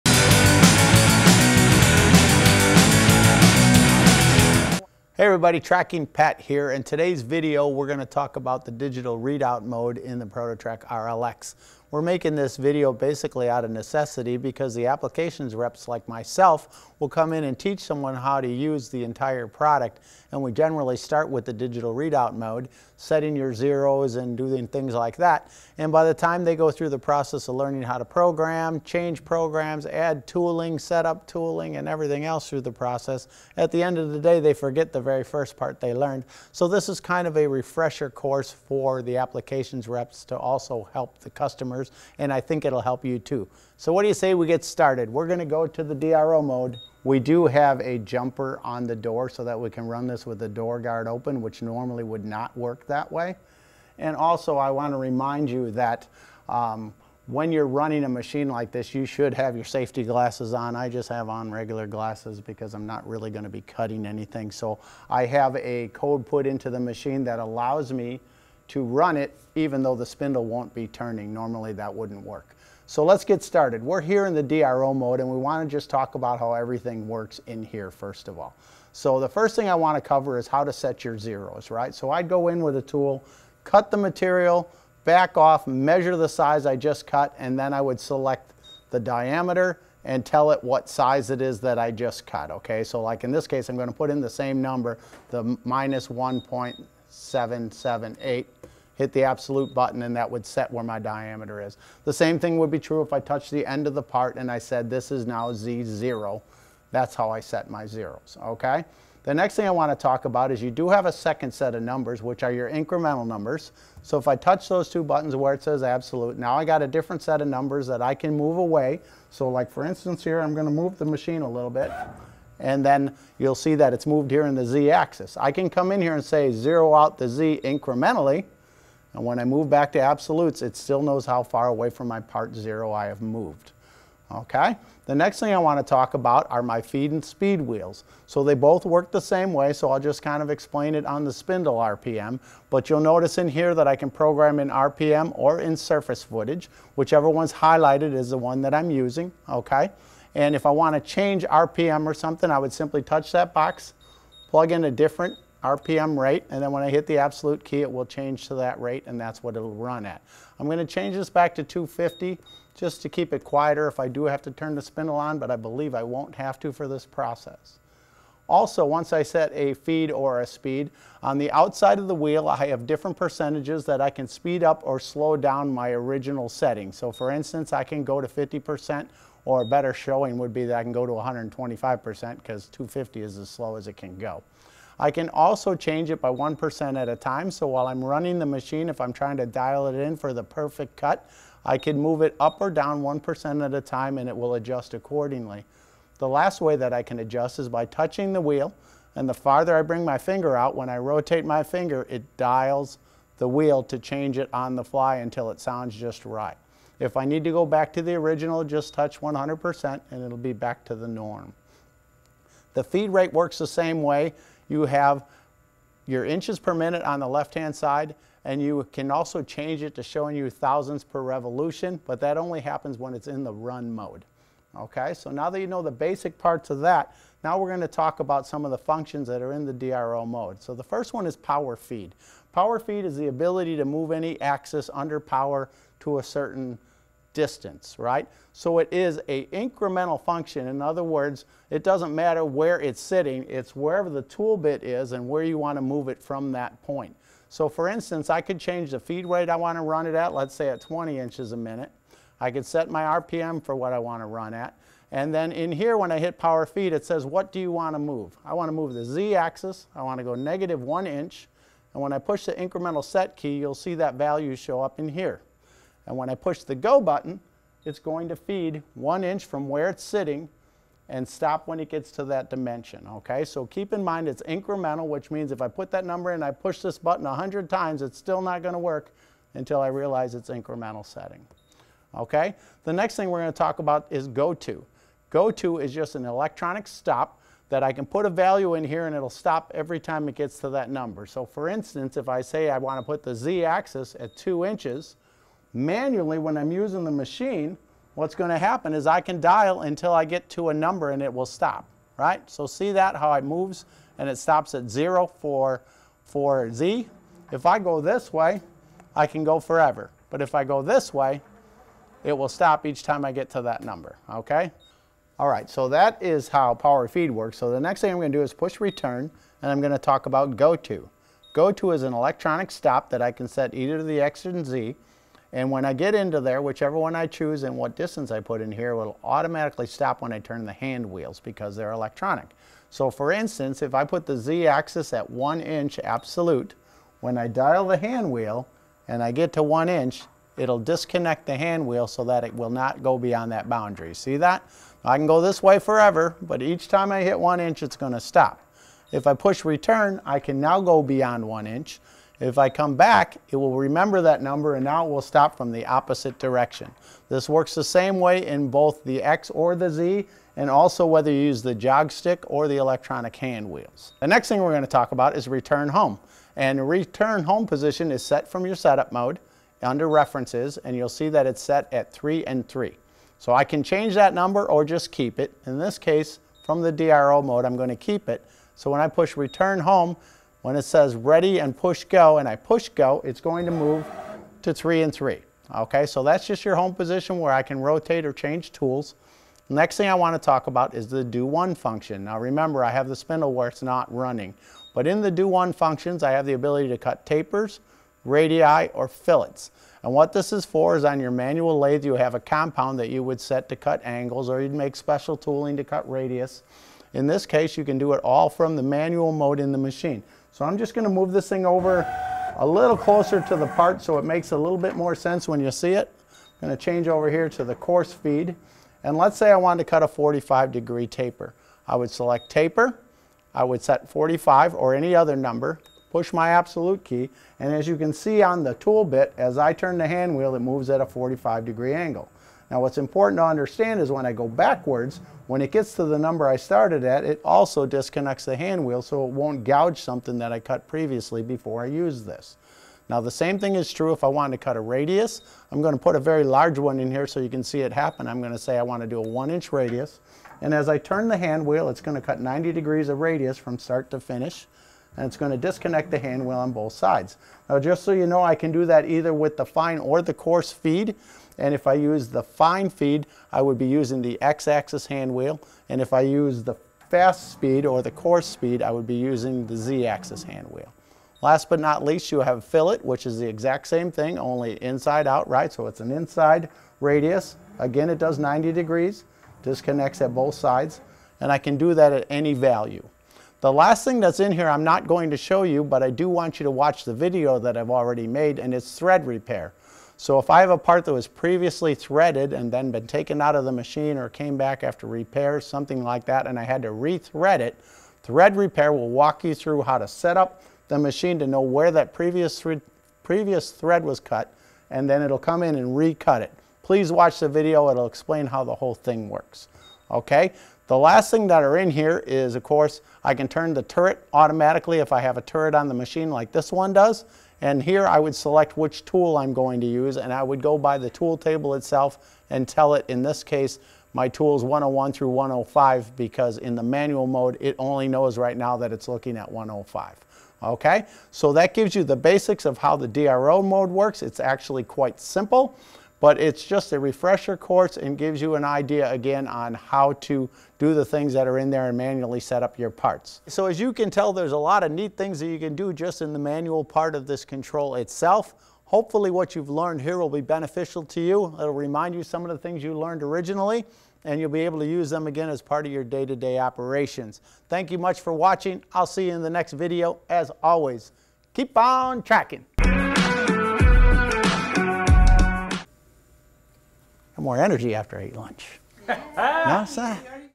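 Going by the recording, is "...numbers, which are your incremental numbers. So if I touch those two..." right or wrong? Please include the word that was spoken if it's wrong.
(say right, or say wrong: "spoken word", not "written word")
right.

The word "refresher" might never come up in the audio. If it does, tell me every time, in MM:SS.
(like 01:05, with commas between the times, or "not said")
00:37, 08:56.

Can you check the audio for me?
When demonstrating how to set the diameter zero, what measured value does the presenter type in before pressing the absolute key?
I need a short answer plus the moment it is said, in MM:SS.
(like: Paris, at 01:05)
-1.778, at 01:35.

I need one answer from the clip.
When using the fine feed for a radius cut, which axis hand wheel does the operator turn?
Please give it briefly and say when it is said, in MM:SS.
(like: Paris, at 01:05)
x-axis, at 07:44.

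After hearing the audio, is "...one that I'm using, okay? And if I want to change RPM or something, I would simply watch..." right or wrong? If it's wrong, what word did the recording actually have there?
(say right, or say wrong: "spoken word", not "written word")
wrong: "touch", not "watch".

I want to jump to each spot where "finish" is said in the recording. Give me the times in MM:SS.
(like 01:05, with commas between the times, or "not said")
07:34.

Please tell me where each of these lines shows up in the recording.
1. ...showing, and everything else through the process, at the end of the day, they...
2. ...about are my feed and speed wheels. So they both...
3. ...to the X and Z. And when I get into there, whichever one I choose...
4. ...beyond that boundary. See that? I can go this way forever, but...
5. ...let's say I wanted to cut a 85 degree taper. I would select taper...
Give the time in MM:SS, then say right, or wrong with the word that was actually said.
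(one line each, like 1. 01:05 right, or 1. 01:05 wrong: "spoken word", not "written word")
1. 00:31 wrong: "tooling", not "showing"
2. 02:16 right
3. 05:23 right
4. 05:43 right
5. 06:59 wrong: "45", not "85".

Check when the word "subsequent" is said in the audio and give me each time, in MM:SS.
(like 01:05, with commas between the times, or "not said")
not said.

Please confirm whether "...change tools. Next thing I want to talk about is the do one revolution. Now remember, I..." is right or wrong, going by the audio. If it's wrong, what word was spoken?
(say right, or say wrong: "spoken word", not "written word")
wrong: "function", not "revolution".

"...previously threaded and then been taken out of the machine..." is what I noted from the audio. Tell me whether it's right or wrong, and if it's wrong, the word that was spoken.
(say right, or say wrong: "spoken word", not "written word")
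right.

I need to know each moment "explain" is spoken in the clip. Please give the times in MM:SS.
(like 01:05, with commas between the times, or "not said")
02:20, 08:28.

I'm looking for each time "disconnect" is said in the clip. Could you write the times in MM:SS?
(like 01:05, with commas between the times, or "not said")
05:40, 07:17, 07:35, 07:59.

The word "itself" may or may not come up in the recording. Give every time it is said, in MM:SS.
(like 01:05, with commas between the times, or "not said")
08:41, 09:07.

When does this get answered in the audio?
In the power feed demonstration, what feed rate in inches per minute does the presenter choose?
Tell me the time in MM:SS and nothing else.
04:10.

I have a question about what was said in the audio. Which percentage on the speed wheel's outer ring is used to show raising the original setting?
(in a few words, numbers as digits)
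125%.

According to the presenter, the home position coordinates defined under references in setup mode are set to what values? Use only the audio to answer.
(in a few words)
3 and 3.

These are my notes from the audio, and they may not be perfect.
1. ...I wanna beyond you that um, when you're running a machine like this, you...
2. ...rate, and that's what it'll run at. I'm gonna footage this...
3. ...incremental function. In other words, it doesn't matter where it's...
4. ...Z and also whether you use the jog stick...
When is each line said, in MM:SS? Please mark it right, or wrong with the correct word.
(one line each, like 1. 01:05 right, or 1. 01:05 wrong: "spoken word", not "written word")
1. 00:54 wrong: "remind", not "beyond"
2. 02:38 wrong: "change", not "footage"
3. 03:59 right
4. 05:59 right.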